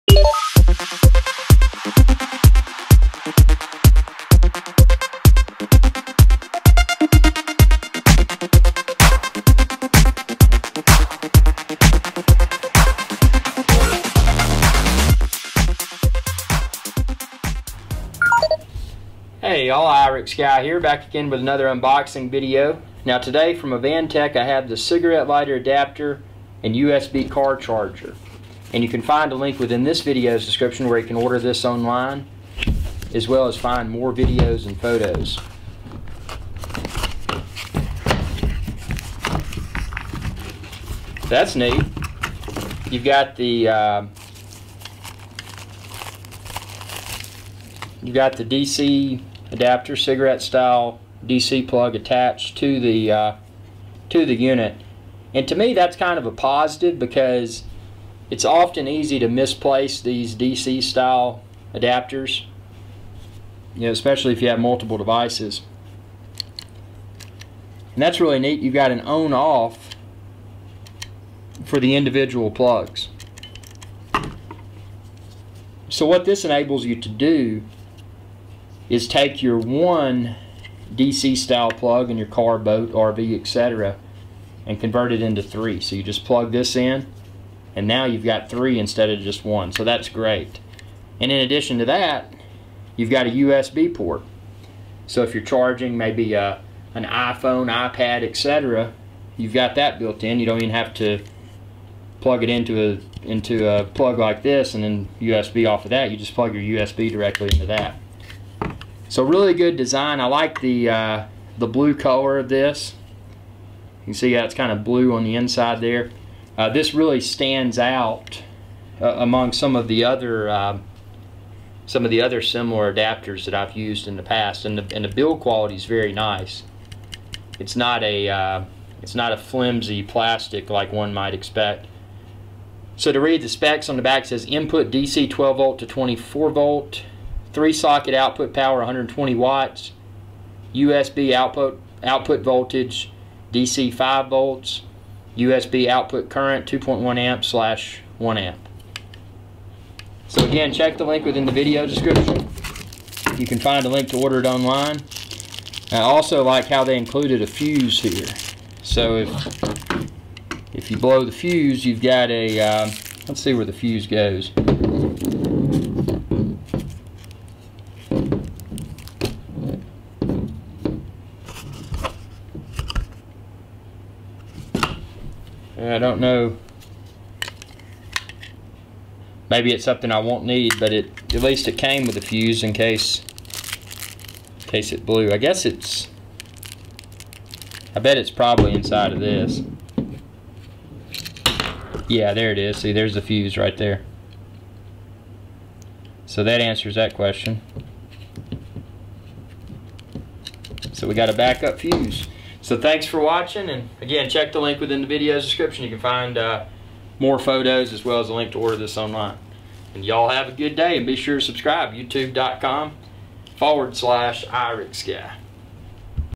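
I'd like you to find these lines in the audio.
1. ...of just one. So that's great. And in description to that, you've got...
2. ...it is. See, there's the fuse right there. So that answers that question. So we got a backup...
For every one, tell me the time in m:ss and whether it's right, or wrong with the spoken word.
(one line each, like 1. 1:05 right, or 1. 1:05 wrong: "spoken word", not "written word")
1. 1:29 wrong: "addition", not "description"
2. 3:12 right.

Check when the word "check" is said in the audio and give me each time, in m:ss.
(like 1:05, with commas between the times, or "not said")
2:30, 3:24.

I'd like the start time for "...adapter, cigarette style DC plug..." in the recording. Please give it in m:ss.
0:49.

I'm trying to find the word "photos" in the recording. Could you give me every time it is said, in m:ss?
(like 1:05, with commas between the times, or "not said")
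0:34, 3:27.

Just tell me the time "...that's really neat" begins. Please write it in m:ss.
1:08.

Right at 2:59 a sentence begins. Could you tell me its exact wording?
Maybe it's something I won't need, but it at least it came with a fuse in case in case it blew.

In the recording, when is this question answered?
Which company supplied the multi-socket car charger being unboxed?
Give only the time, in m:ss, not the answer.
0:23.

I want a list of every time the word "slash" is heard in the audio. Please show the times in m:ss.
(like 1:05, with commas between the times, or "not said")
2:27, 3:33.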